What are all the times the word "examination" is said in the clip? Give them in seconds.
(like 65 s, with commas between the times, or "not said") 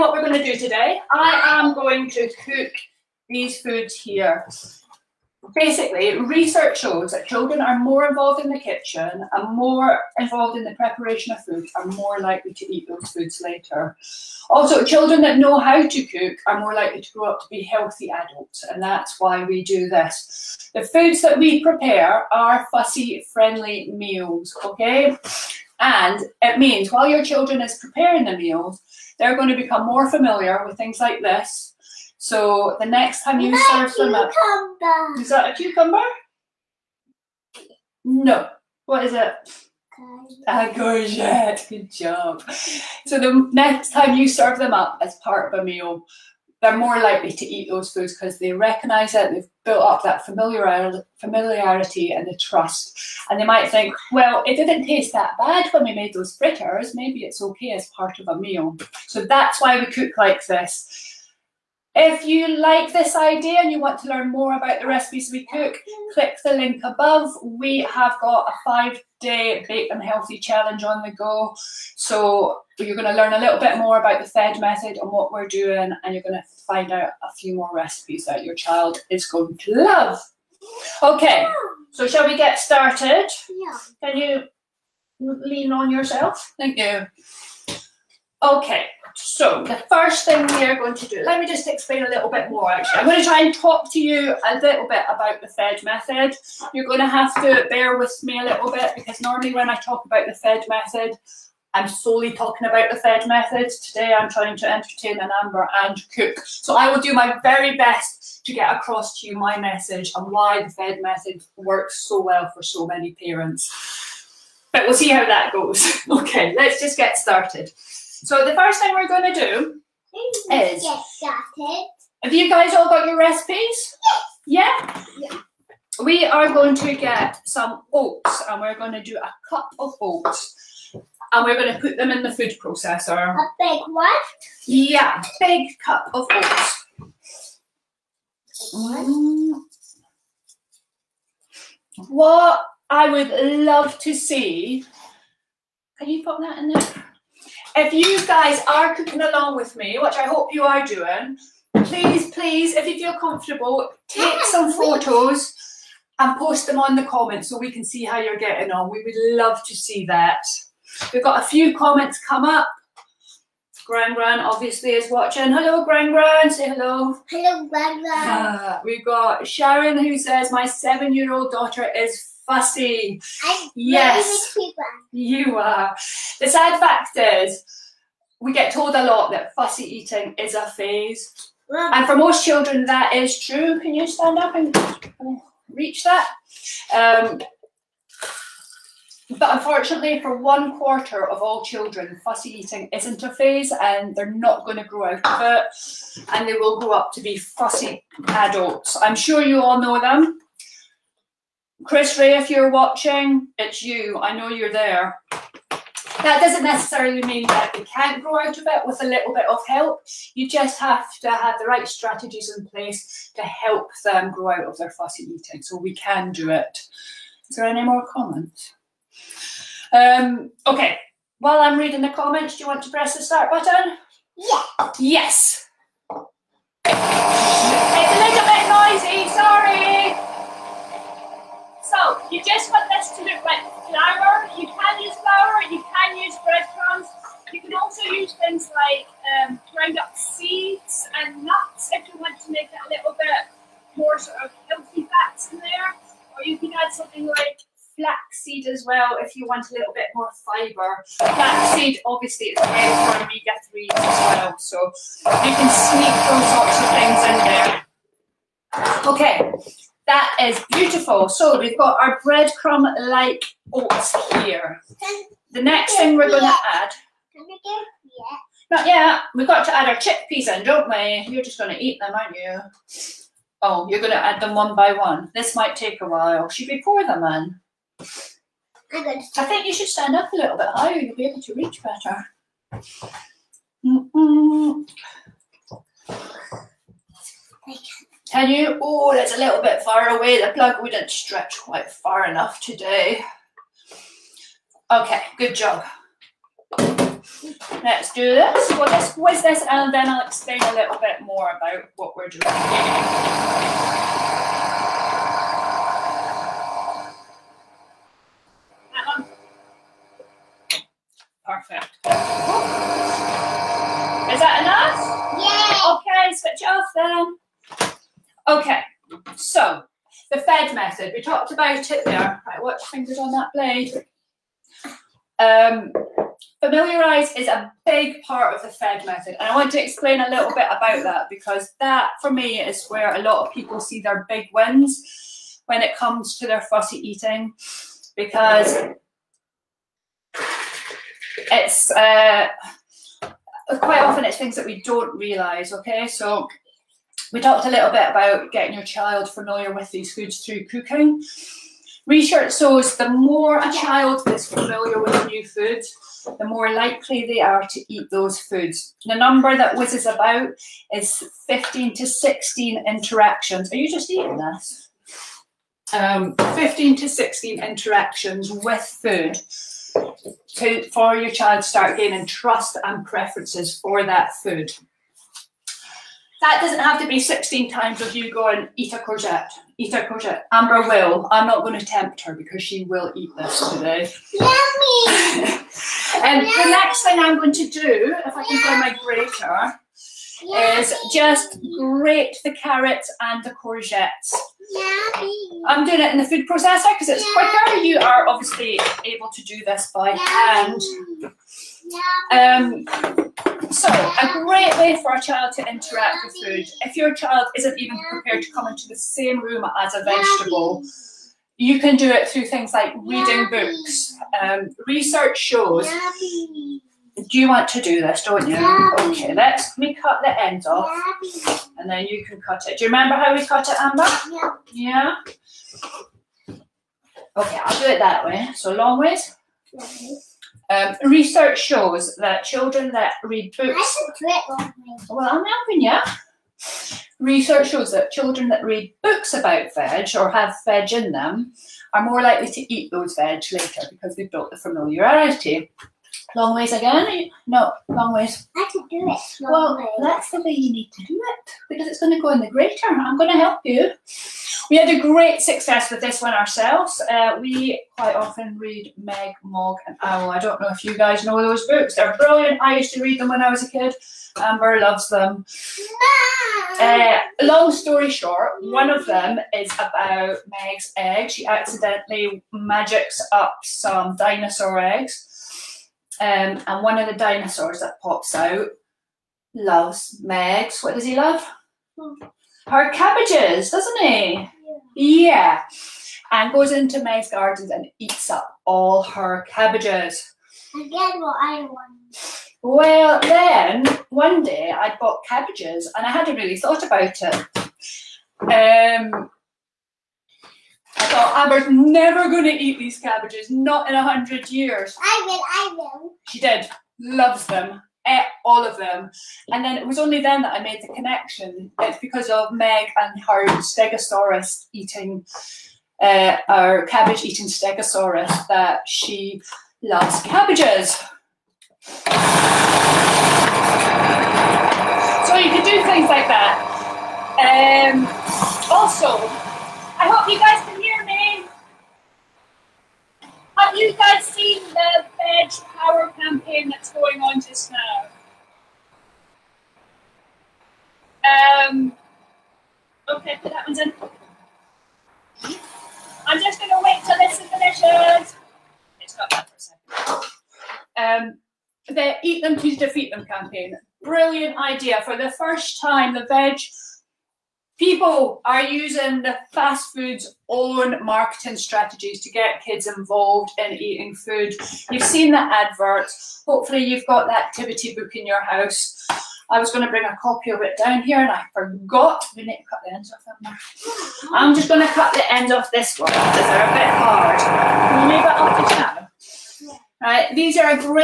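not said.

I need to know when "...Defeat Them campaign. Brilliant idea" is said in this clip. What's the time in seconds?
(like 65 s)
552 s.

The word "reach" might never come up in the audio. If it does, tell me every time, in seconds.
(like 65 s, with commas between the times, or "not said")
185 s, 281 s.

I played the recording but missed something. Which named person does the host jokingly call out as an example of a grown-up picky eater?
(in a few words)
Chris Ray.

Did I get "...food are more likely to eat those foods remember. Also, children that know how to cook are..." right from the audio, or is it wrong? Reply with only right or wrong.
wrong.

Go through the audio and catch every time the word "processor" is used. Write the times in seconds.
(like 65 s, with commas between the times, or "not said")
132 s, 396 s.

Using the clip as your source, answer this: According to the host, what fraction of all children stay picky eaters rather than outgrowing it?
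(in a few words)
One quarter.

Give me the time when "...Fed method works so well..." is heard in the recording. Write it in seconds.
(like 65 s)
110 s.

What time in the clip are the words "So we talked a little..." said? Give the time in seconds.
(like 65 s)
346 s.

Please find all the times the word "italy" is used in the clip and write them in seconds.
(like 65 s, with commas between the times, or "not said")
not said.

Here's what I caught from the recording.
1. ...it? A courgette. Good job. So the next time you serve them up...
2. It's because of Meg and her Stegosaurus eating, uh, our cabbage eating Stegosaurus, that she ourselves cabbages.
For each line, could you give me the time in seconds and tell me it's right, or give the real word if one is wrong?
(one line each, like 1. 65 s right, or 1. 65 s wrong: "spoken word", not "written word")
1. 39 s right
2. 511 s wrong: "loves", not "ourselves".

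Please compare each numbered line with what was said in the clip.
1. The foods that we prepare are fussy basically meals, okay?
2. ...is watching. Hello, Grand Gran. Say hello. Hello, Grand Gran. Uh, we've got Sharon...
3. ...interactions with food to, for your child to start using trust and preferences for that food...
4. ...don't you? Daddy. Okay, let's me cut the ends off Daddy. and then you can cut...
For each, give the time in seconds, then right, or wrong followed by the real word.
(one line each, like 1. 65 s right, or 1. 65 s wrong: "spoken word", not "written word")
1. 20 s wrong: "friendly", not "basically"
2. 164 s right
3. 367 s wrong: "gaining", not "using"
4. 418 s right.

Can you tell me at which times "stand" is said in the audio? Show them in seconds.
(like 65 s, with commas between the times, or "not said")
184 s, 279 s.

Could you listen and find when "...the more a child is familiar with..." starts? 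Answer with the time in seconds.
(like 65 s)
352 s.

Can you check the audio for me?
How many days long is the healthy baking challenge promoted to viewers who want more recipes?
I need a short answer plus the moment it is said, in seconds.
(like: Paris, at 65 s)
5, at 68 s.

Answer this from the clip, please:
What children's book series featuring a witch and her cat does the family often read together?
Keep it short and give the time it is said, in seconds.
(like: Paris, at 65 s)
Meg, Mog, and Owl, at 458 s.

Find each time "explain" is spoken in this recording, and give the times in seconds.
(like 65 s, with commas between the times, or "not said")
91 s, 300 s, 329 s.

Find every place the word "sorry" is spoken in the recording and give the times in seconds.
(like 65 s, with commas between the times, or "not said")
229 s.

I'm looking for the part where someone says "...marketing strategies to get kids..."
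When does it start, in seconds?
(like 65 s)
561 s.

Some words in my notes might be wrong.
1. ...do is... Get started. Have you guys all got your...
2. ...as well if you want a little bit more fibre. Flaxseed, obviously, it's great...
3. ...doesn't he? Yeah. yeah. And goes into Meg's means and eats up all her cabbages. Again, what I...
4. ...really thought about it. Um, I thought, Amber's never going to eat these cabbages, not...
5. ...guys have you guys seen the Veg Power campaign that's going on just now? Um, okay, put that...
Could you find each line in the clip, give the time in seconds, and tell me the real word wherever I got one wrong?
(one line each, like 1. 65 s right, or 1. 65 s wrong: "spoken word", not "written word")
1. 119 s right
2. 248 s right
3. 483 s wrong: "gardens", not "means"
4. 496 s right
5. 530 s right.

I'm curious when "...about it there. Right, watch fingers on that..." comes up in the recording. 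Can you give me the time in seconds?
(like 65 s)
321 s.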